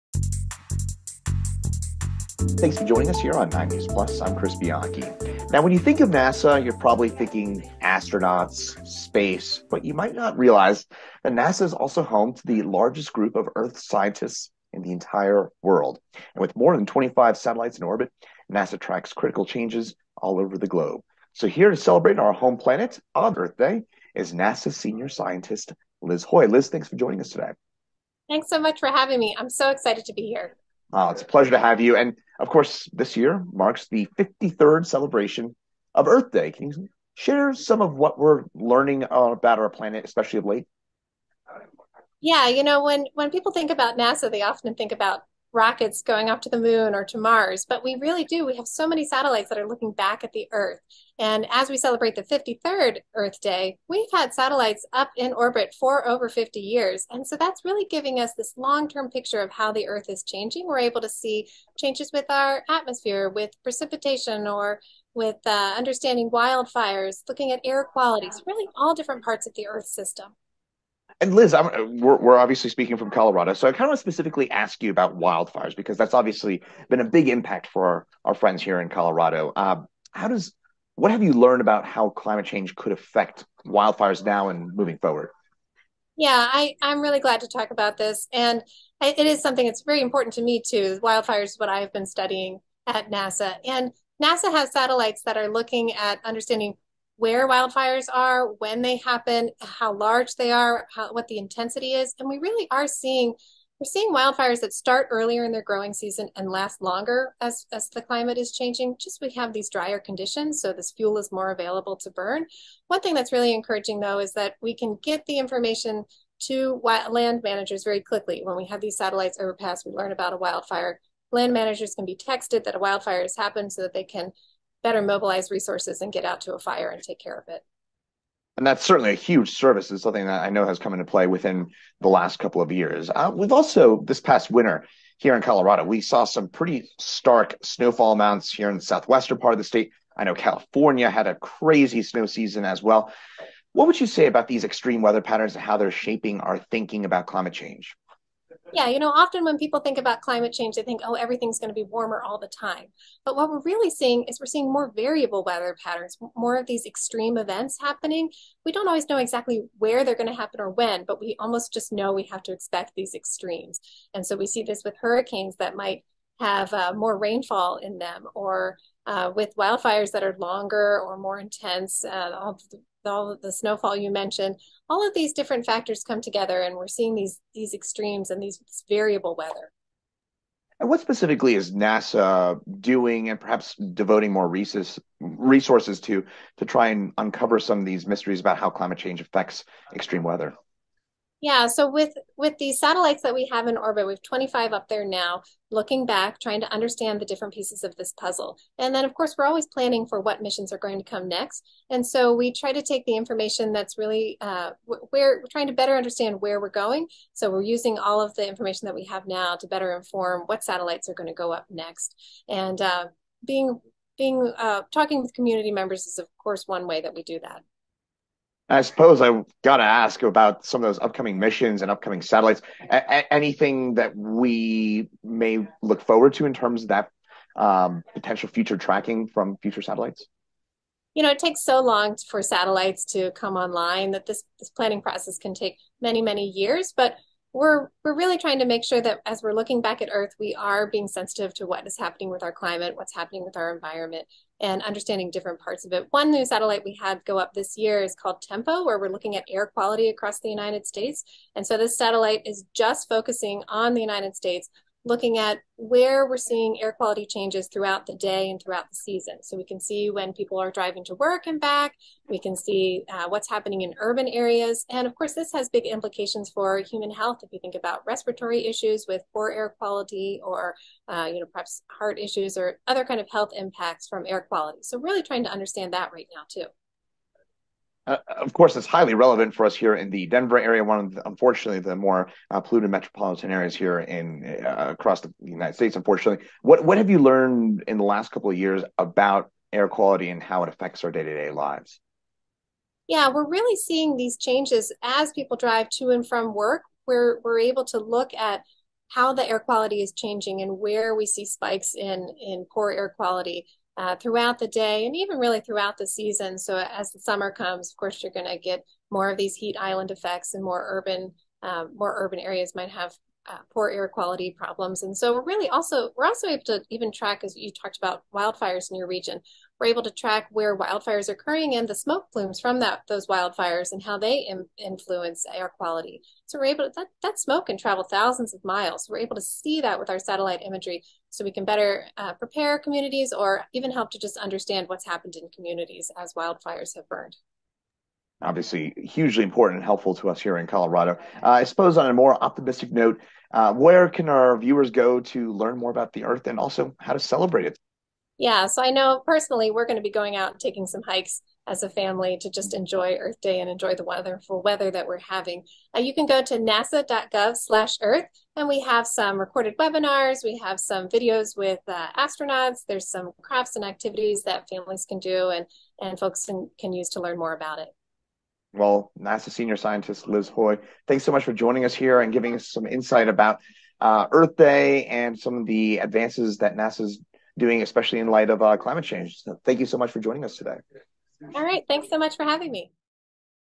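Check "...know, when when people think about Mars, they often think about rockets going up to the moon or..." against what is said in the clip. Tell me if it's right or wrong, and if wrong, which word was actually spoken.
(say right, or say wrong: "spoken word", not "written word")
wrong: "NASA", not "Mars".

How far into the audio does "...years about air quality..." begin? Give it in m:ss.
4:48.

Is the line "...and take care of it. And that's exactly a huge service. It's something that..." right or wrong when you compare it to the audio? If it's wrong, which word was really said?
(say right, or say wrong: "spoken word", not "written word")
wrong: "certainly", not "exactly".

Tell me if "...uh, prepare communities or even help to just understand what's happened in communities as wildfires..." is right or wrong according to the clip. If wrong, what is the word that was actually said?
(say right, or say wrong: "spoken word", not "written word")
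right.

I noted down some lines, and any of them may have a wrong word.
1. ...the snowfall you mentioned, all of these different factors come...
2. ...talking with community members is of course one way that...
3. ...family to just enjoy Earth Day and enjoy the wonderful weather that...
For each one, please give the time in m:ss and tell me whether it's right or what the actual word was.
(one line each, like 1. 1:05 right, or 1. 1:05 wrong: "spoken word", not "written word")
1. 2:53 right
2. 3:34 right
3. 5:51 right.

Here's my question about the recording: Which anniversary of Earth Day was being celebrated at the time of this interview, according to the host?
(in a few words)
53rd.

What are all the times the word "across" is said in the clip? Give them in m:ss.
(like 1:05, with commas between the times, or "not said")
4:10, 4:44.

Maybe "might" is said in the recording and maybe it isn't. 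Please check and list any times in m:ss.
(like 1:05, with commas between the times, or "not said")
0:09, 2:45, 5:12.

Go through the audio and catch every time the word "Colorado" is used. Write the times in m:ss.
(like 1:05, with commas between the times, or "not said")
1:13, 1:18, 2:15, 5:40.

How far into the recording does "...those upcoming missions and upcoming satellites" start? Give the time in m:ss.
3:40.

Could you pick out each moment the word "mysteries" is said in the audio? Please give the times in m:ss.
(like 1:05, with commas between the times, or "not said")
3:08.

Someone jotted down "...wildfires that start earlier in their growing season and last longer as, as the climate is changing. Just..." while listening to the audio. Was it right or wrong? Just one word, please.
right.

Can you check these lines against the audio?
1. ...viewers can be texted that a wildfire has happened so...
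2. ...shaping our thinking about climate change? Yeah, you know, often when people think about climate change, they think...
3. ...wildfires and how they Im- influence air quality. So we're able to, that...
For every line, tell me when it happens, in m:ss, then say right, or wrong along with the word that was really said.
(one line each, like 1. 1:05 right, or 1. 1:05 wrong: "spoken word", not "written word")
1. 2:01 wrong: "managers", not "viewers"
2. 2:25 right
3. 5:23 right.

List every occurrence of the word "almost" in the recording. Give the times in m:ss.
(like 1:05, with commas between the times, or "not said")
2:41.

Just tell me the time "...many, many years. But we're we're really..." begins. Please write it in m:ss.
3:55.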